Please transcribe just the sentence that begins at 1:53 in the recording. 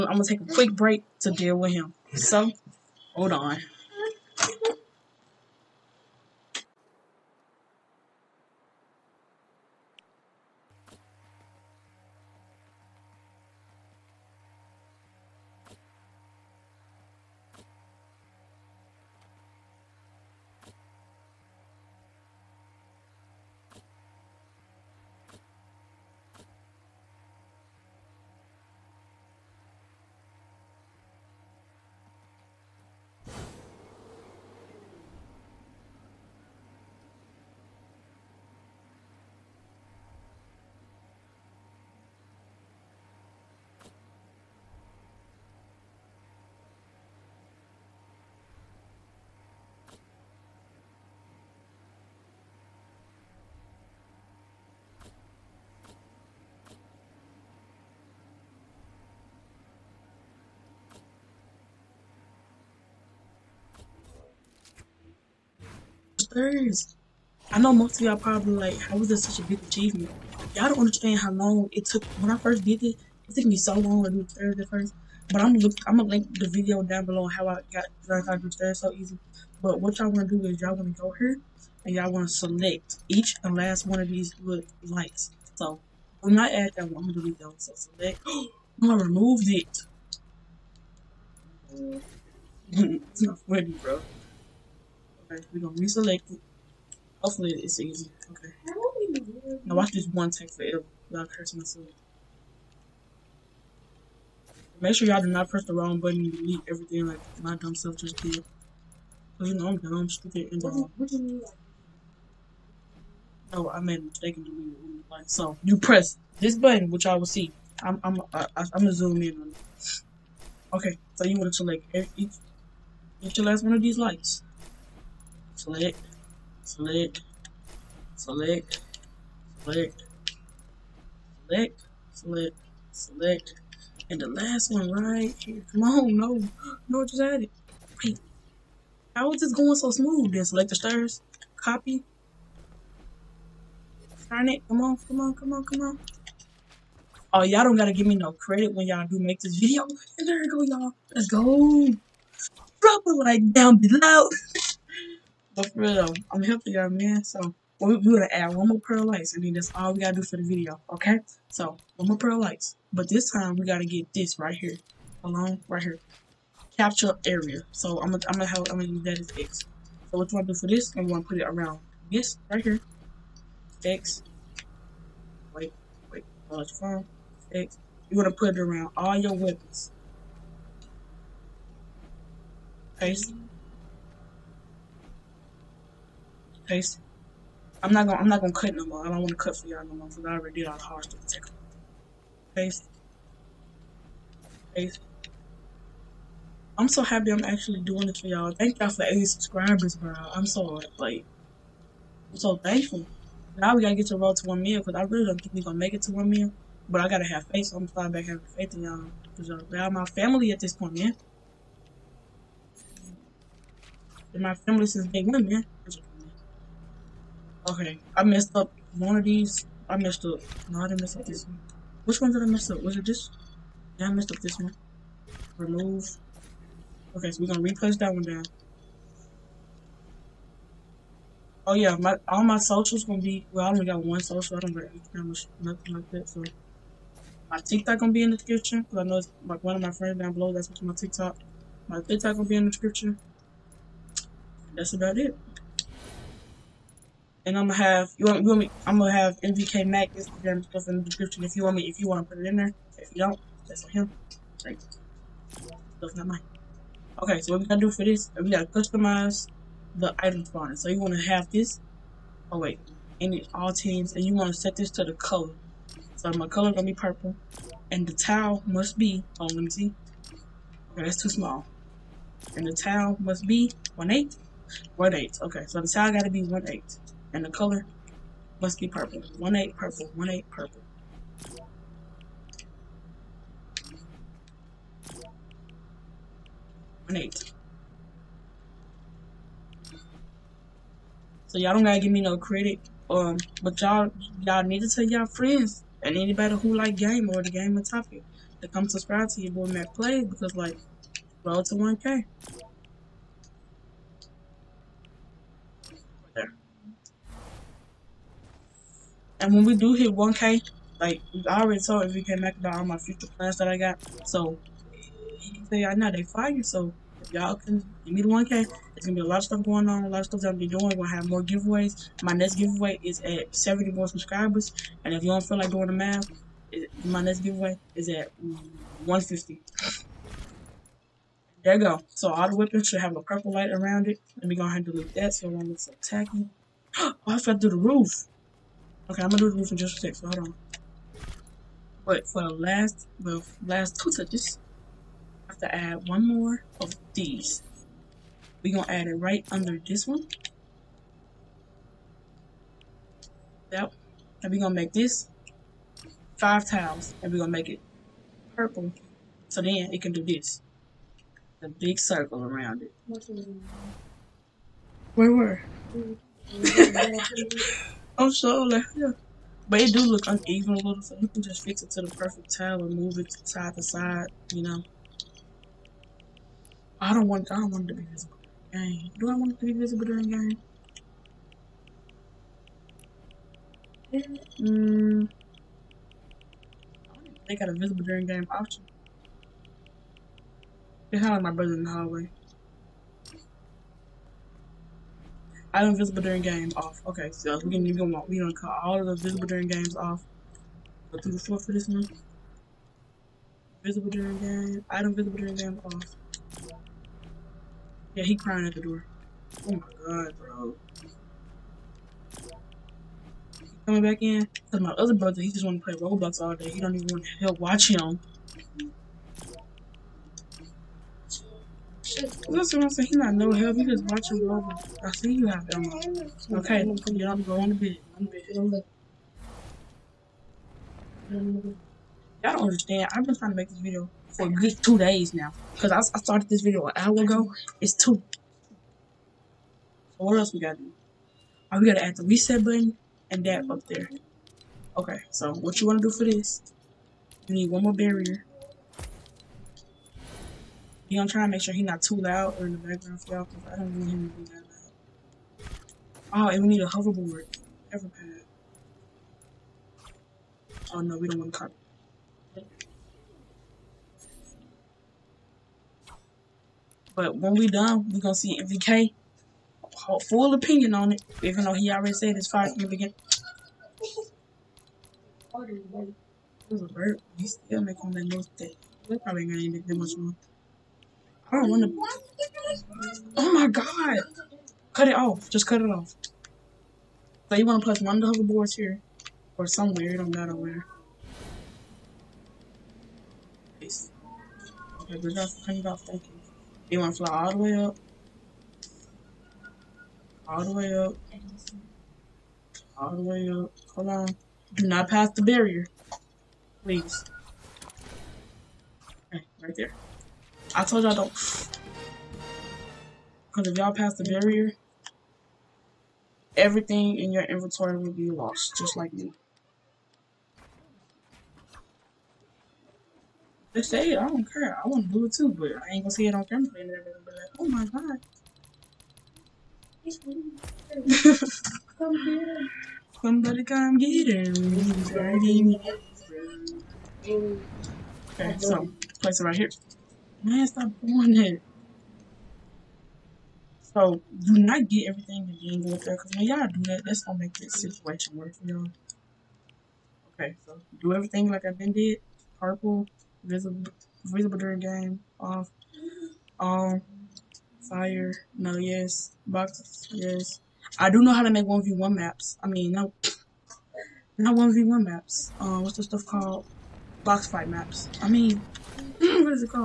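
Oh, I made a mistake in deleting like so.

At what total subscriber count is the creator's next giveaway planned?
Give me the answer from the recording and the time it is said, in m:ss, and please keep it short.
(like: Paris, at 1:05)
150, at 5:28.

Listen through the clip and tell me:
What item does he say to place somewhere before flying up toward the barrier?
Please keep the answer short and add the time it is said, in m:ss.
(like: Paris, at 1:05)
Hoverboard, at 8:08.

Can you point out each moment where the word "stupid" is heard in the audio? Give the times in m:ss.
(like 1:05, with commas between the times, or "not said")
1:50.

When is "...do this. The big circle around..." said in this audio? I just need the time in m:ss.
6:00.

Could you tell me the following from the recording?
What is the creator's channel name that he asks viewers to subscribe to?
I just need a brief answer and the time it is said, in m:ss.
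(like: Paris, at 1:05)
MacPlayz, at 4:59.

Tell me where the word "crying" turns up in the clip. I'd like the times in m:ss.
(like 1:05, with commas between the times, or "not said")
6:48.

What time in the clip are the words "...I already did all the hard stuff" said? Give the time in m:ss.
3:10.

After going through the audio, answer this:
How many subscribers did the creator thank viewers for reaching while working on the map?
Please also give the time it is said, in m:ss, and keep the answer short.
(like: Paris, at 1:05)
80, at 3:19.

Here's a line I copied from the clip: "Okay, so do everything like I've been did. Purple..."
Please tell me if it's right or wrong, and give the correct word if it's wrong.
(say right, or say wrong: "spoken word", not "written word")
right.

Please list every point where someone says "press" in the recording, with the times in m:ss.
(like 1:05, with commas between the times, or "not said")
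1:45, 1:55.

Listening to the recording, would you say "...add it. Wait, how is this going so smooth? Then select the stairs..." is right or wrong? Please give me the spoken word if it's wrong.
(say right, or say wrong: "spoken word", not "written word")
right.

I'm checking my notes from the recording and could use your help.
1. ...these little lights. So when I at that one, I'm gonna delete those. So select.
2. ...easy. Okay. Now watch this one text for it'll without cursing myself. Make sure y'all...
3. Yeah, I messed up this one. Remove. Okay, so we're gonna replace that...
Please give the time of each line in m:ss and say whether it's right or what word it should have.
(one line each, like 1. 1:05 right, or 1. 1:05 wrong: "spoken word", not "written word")
1. 1:24 right
2. 1:37 right
3. 3:43 right.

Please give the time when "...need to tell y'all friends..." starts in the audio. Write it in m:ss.
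4:54.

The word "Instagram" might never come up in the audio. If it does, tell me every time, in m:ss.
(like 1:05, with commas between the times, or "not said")
3:54, 4:10.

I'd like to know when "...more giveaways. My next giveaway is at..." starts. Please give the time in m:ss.
5:21.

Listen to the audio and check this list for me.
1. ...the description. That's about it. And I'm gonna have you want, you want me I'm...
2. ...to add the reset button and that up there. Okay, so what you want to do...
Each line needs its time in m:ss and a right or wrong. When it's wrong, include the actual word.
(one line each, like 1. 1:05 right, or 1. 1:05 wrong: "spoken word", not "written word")
1. 4:02 right
2. 7:21 right.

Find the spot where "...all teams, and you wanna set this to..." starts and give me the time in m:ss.
4:23.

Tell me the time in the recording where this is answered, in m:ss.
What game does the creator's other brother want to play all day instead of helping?
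6:55.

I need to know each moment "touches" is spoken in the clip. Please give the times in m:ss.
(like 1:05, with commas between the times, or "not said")
5:44.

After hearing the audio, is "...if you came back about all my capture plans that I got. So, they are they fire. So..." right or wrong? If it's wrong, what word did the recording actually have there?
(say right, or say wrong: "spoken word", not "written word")
wrong: "future", not "capture".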